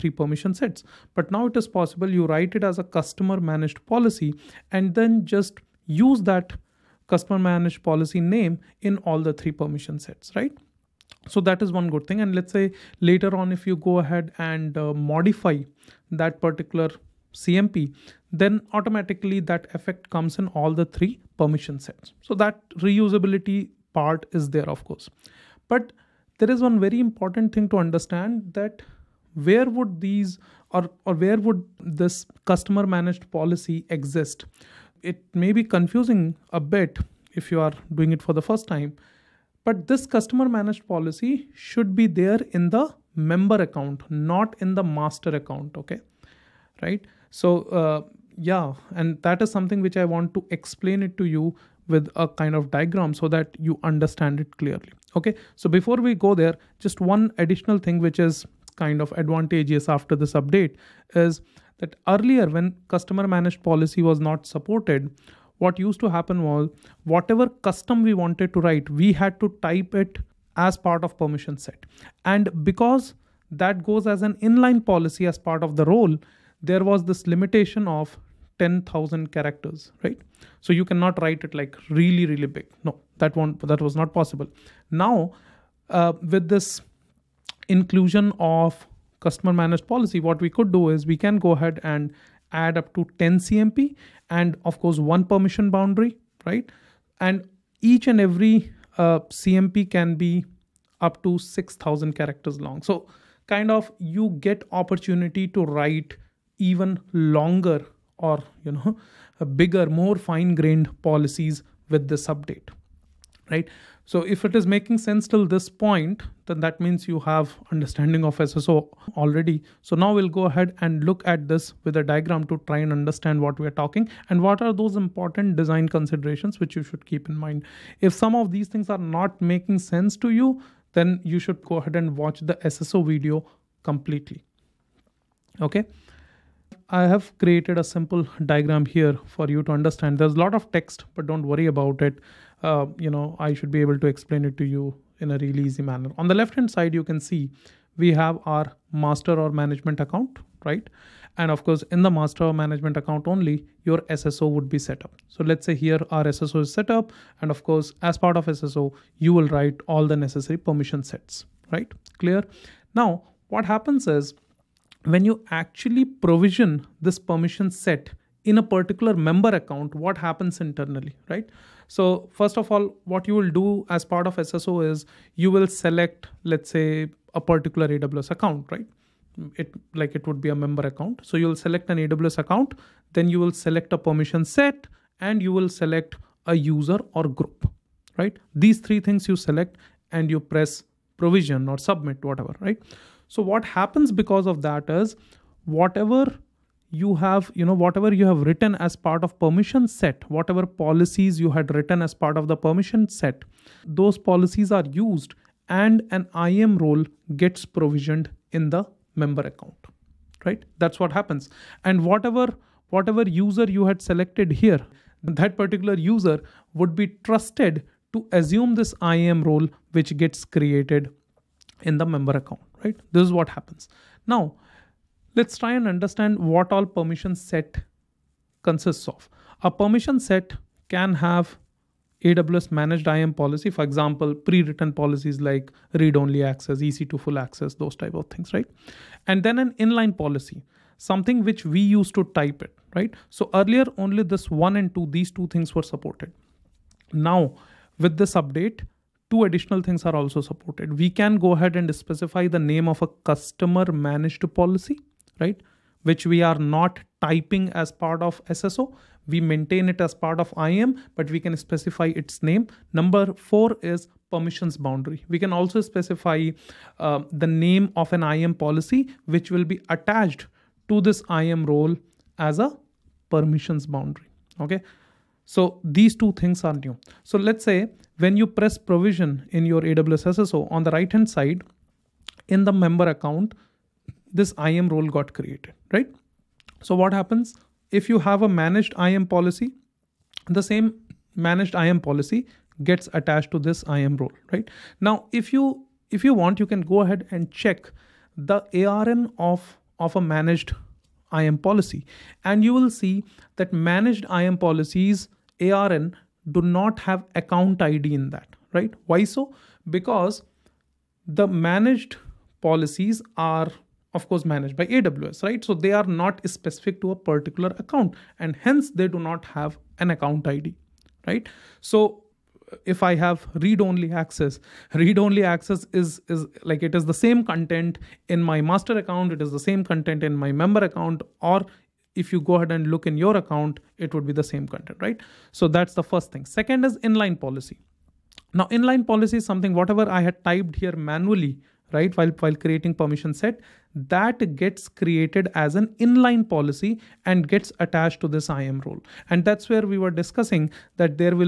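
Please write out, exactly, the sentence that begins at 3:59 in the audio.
And then an inline policy, something which we used to type it, right?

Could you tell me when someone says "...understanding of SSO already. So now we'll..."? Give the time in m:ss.
1:57.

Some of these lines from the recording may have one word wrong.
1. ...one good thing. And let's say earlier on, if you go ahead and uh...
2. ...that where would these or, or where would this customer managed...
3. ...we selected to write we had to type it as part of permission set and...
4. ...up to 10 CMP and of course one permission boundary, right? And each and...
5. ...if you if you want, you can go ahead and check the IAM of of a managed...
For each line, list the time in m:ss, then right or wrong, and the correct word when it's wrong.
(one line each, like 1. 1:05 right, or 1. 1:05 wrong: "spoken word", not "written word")
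1. 0:11 wrong: "later", not "earlier"
2. 0:28 right
3. 1:08 wrong: "wanted", not "selected"
4. 1:32 right
5. 4:55 wrong: "ARN", not "IAM".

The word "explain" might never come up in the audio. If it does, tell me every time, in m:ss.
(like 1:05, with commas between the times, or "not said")
0:50, 2:24.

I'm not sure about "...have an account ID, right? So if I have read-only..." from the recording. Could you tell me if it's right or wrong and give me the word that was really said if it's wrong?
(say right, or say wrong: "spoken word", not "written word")
right.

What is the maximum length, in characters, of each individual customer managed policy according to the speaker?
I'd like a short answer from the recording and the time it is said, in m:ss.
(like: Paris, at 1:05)
6000 characters, at 1:41.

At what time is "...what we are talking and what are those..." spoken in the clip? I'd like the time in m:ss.
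2:03.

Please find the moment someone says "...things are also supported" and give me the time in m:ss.
4:09.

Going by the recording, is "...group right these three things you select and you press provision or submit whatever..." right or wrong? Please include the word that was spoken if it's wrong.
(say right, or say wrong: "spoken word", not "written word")
right.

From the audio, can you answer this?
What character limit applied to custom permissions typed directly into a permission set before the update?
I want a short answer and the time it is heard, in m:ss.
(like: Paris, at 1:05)
10000 characters, at 1:18.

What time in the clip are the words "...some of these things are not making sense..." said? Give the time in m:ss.
2:08.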